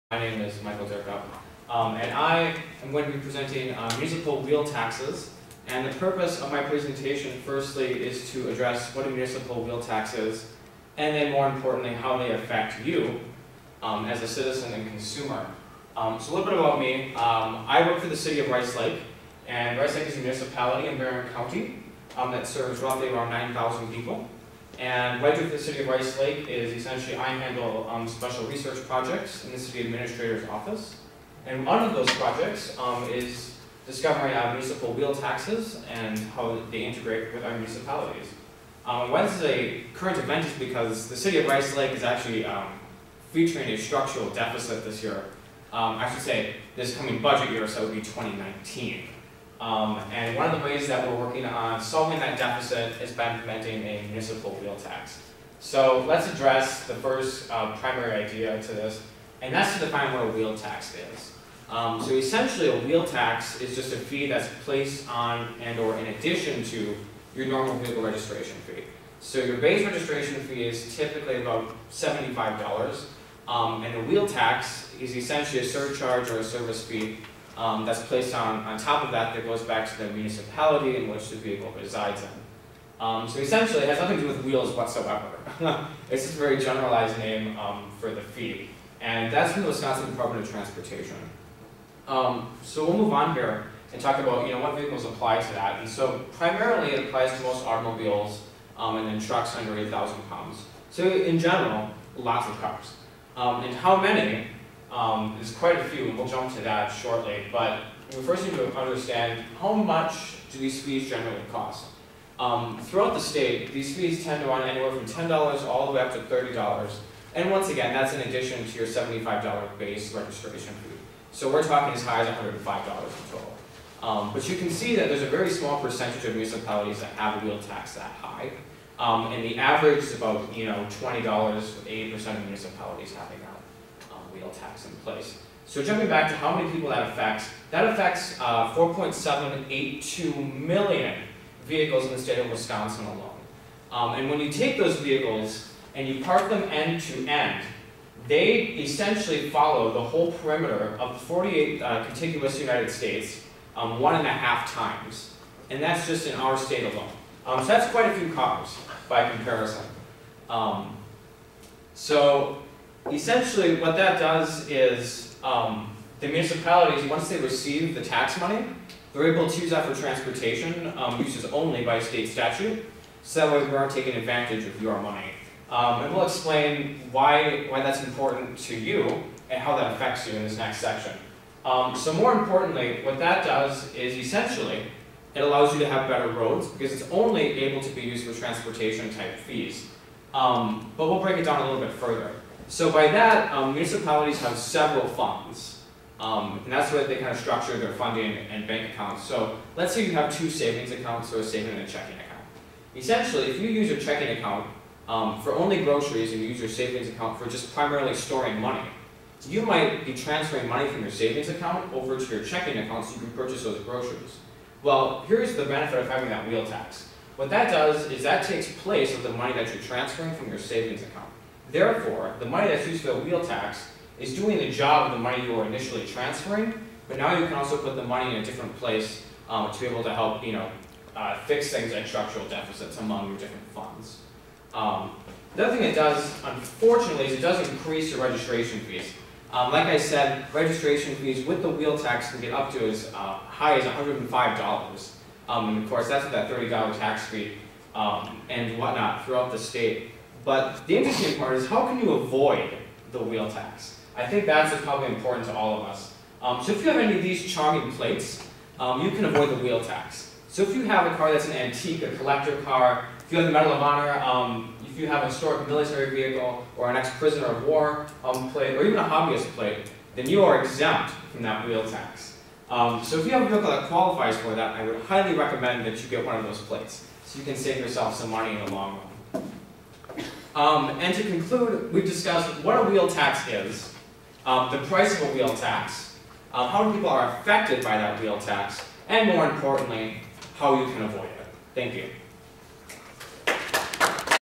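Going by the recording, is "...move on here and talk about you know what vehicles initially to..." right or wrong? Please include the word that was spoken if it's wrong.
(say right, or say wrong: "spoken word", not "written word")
wrong: "apply", not "initially".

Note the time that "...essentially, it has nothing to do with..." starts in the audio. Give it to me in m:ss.
1:23.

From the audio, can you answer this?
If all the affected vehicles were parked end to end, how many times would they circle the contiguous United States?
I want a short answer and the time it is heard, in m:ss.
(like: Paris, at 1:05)
1.5 times, at 2:33.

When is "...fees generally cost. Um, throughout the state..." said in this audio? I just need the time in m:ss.
1:50.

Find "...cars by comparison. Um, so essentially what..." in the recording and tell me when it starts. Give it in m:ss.
2:38.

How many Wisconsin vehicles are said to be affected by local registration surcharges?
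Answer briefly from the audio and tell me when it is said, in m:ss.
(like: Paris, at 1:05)
4.782 million, at 2:18.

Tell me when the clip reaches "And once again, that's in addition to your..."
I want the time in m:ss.
1:57.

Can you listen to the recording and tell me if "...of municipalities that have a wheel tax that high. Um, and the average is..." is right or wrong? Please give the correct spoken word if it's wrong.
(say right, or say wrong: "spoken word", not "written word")
right.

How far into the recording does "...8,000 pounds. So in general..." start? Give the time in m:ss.
1:39.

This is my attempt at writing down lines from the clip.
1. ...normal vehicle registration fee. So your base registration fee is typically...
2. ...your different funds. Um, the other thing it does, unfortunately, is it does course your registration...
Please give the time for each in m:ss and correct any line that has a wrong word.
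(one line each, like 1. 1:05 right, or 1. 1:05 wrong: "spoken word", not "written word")
1. 1:07 right
2. 3:53 wrong: "increase", not "course".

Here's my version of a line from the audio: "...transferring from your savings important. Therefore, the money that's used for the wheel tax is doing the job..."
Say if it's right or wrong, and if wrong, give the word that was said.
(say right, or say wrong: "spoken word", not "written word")
wrong: "account", not "important".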